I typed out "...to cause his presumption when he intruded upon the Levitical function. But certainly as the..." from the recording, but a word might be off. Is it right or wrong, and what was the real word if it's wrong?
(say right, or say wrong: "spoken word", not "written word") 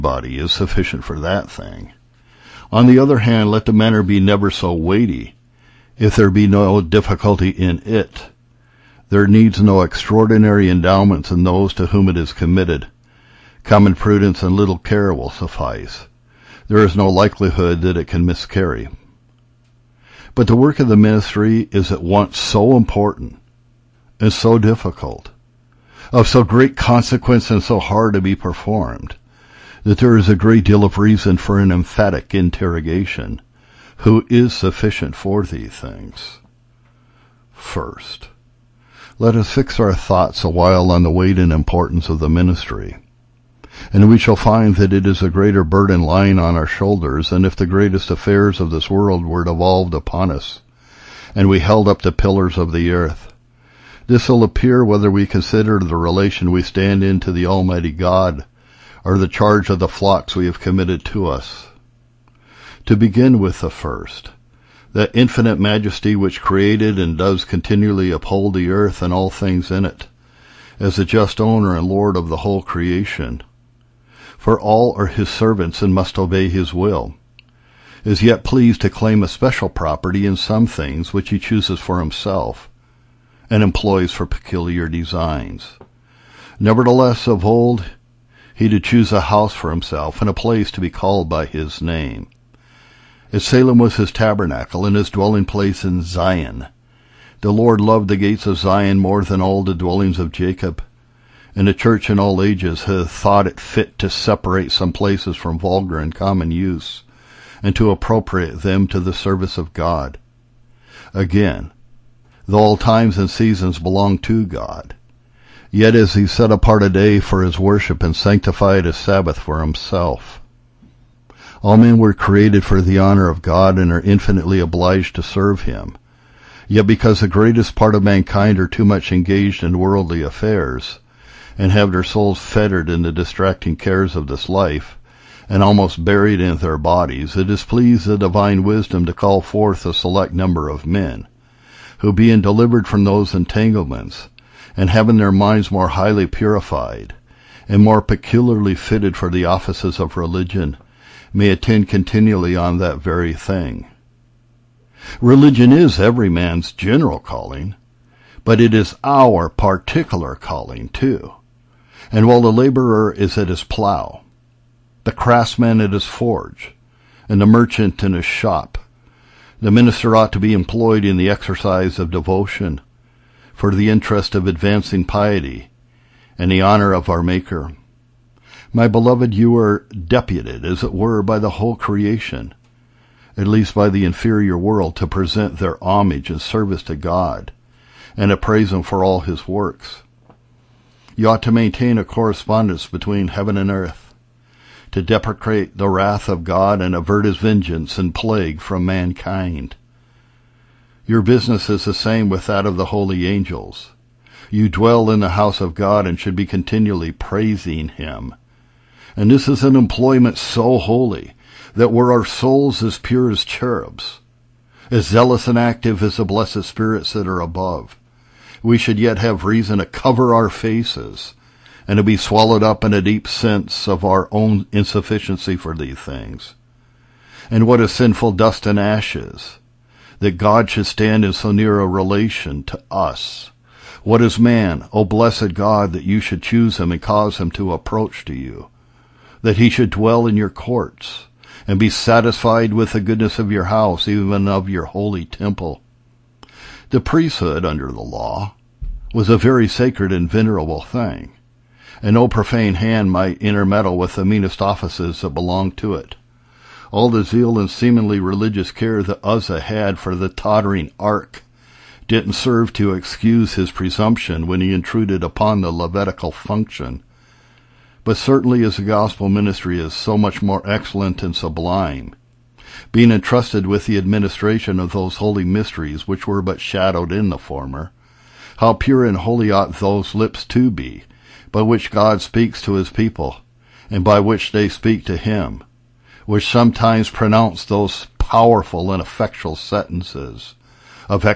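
wrong: "excuse", not "cause".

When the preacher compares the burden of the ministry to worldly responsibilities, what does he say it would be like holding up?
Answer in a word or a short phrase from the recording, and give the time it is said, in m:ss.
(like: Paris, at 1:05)
the pillars of the earth, at 0:52.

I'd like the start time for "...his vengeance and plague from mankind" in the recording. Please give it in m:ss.
3:17.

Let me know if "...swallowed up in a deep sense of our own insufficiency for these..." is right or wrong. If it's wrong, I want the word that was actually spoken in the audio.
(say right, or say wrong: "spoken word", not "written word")
right.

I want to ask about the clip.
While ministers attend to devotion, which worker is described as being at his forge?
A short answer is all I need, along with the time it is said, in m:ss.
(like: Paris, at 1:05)
the craftsman, at 2:45.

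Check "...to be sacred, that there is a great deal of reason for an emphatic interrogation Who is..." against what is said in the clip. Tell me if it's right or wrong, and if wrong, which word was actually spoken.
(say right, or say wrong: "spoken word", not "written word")
wrong: "performed", not "sacred".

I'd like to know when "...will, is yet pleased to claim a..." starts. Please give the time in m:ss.
1:16.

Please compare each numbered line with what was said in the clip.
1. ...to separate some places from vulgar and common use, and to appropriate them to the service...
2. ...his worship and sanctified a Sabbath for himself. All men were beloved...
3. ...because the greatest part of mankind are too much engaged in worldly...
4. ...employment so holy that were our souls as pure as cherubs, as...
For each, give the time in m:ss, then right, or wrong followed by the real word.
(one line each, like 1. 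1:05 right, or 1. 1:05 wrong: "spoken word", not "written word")
1. 1:43 right
2. 1:57 wrong: "created", not "beloved"
3. 2:06 right
4. 3:29 right.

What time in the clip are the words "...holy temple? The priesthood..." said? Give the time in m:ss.
4:04.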